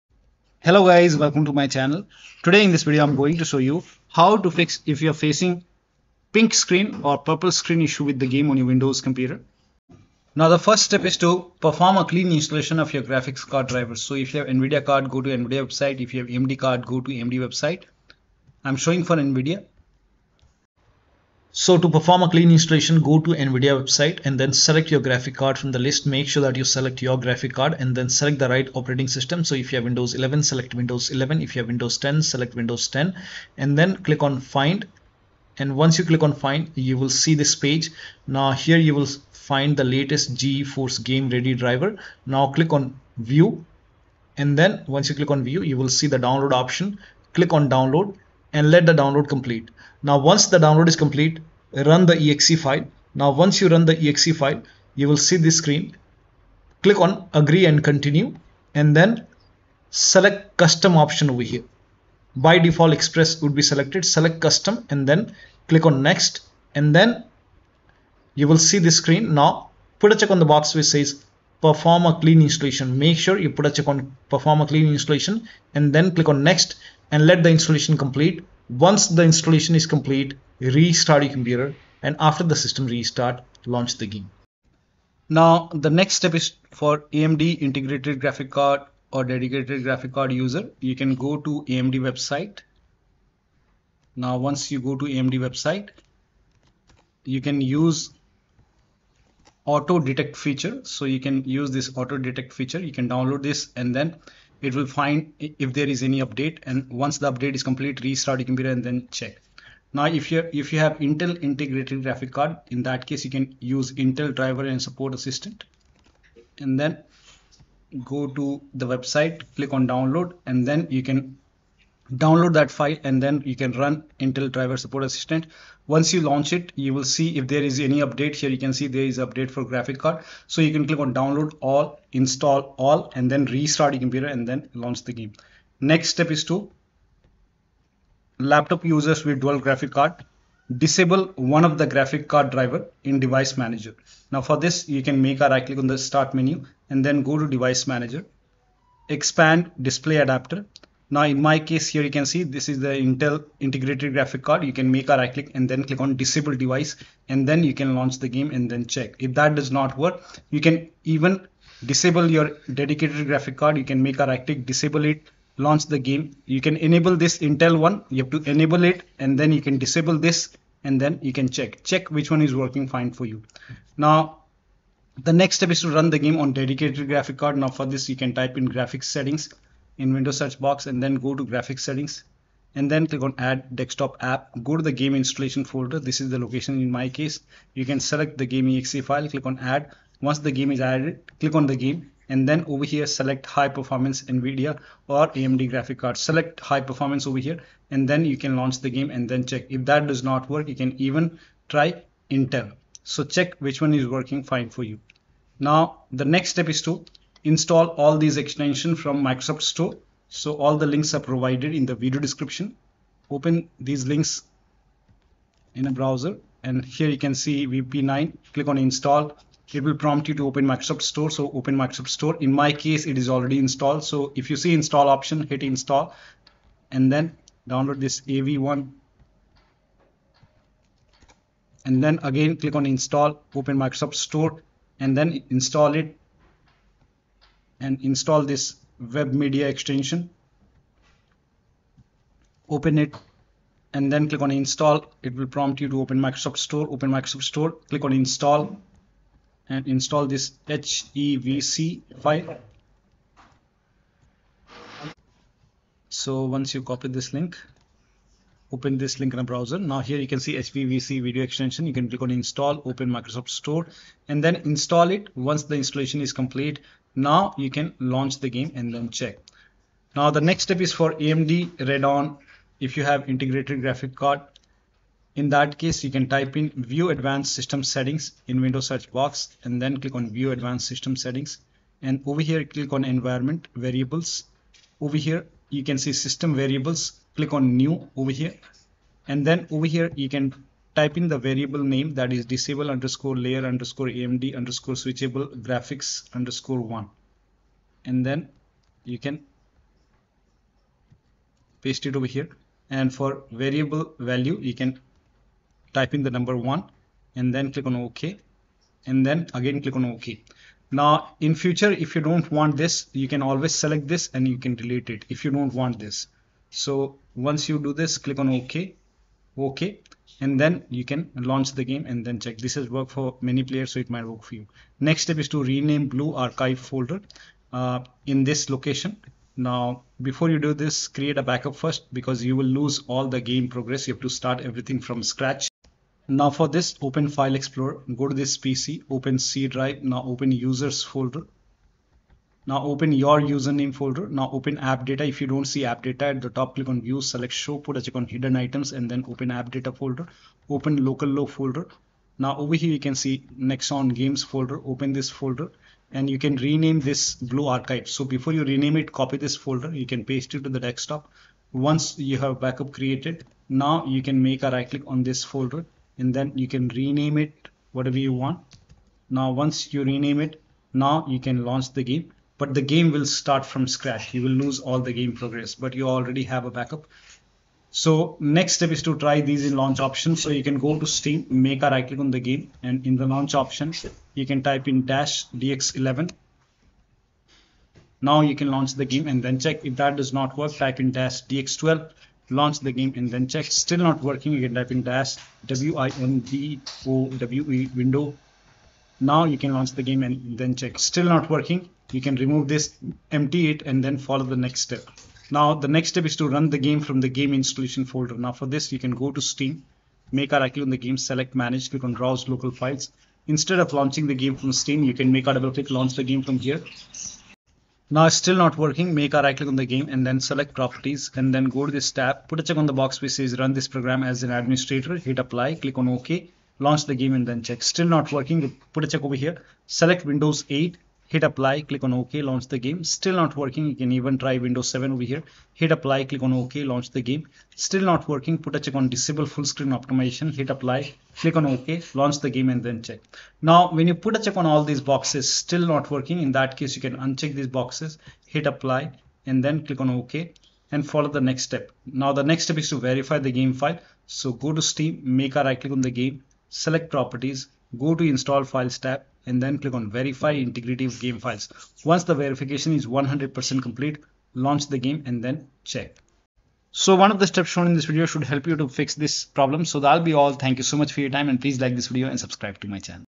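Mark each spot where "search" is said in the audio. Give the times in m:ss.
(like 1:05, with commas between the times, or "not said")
3:00, 4:38.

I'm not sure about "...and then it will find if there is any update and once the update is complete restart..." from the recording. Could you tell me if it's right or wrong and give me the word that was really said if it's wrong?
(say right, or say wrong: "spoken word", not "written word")
right.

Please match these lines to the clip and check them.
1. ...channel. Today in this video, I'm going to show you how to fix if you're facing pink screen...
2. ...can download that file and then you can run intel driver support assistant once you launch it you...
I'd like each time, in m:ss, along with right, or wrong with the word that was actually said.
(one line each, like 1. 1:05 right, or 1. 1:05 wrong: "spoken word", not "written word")
1. 0:01 right
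2. 2:01 right.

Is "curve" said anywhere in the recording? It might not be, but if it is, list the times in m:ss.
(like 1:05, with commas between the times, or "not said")
not said.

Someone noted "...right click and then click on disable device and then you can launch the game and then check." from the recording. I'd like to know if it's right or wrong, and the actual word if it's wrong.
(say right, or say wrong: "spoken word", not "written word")
right.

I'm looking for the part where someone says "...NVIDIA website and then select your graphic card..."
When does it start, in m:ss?
0:23.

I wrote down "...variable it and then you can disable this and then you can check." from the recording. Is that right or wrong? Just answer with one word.
wrong.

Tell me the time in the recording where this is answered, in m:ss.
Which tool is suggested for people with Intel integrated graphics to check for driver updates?
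1:54.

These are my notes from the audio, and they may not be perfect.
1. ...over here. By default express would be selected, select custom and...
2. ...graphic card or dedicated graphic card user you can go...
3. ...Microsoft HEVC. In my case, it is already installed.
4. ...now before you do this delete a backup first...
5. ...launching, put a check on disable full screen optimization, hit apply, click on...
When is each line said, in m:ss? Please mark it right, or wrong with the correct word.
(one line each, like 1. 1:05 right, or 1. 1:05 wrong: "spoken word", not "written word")
1. 1:01 right
2. 1:28 right
3. 3:41 wrong: "Store", not "HEVC"
4. 5:29 wrong: "create", not "delete"
5. 7:18 wrong: "working", not "launching".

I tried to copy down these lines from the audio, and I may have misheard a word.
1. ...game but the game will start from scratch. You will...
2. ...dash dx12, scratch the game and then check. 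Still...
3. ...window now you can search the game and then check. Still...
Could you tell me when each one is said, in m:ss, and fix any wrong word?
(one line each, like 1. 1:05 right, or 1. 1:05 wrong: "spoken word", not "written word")
1. 6:12 right
2. 6:31 wrong: "launch", not "scratch"
3. 6:37 wrong: "launch", not "search".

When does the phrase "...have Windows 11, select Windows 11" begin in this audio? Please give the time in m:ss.
0:29.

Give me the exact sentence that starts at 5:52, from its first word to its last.
Now over here you can see Nexon games folder, open this folder and you can rename this blue archive.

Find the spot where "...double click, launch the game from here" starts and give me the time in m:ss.
6:55.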